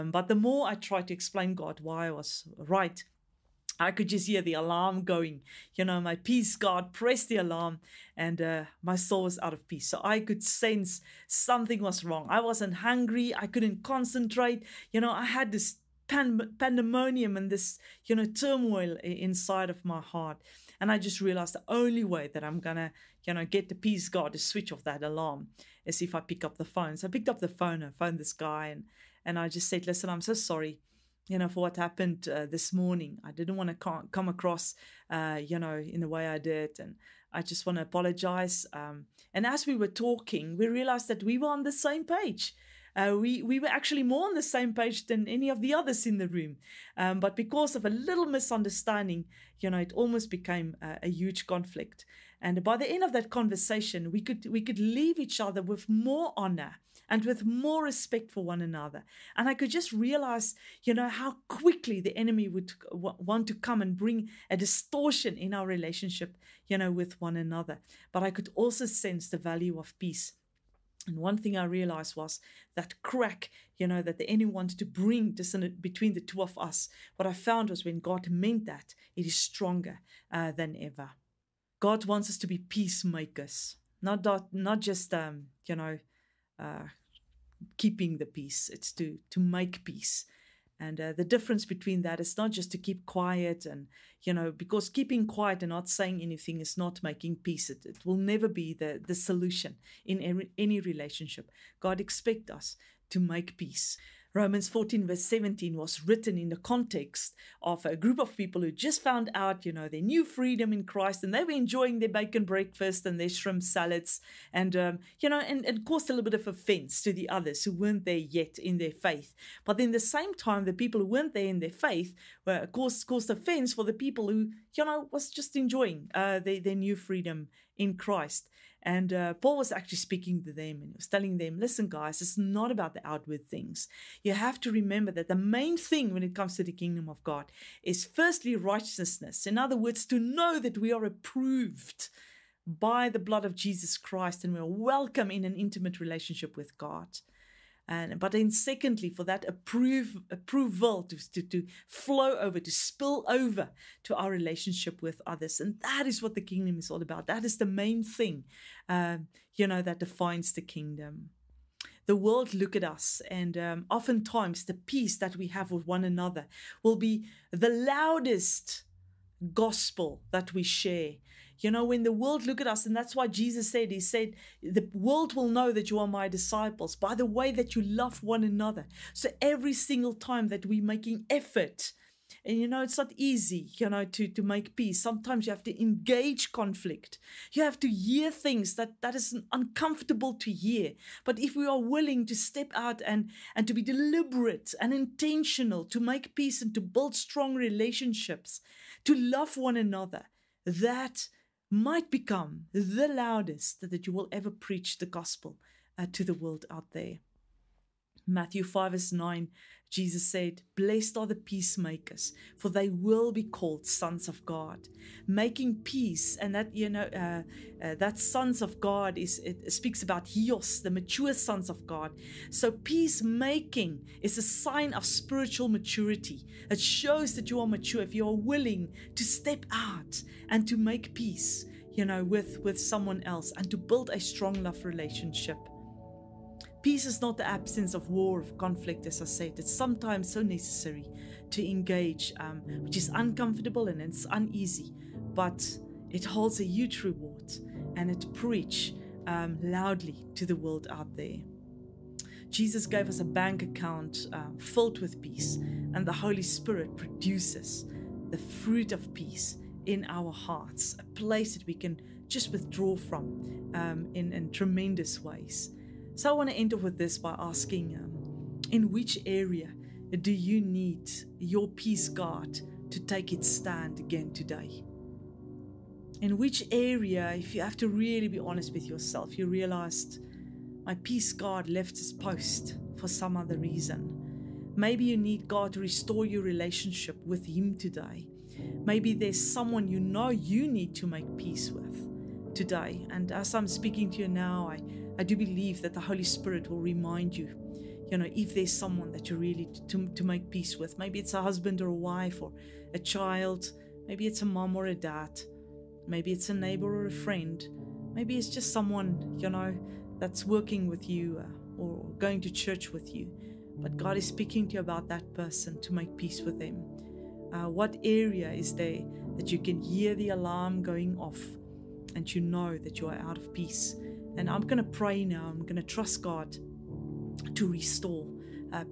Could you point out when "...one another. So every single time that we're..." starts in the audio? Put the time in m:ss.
2:58.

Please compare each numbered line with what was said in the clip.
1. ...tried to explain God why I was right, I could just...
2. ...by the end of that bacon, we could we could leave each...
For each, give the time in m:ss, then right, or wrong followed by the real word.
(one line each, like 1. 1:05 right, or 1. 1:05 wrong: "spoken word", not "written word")
1. 0:00 right
2. 0:52 wrong: "conversation", not "bacon".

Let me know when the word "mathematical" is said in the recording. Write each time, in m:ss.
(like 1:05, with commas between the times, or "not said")
not said.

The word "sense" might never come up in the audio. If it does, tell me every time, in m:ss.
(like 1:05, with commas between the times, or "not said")
0:10, 1:08.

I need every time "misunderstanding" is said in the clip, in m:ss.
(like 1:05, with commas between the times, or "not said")
0:48.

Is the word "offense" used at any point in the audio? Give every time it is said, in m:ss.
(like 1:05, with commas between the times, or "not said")
1:56, 2:03.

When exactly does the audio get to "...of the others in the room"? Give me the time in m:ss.
0:45.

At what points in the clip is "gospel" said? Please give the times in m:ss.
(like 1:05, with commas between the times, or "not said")
2:49, 3:25.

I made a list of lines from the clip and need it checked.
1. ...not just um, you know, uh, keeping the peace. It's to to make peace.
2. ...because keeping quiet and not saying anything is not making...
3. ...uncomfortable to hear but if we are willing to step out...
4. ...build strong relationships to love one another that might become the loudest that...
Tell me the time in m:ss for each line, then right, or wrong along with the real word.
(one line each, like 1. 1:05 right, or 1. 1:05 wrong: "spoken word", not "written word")
1. 1:24 right
2. 1:34 right
3. 3:09 right
4. 3:16 right.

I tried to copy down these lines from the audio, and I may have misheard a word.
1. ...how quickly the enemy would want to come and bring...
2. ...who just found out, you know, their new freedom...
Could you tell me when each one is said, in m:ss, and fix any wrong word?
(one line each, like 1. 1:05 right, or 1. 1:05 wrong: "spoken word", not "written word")
1. 1:01 right
2. 1:48 right.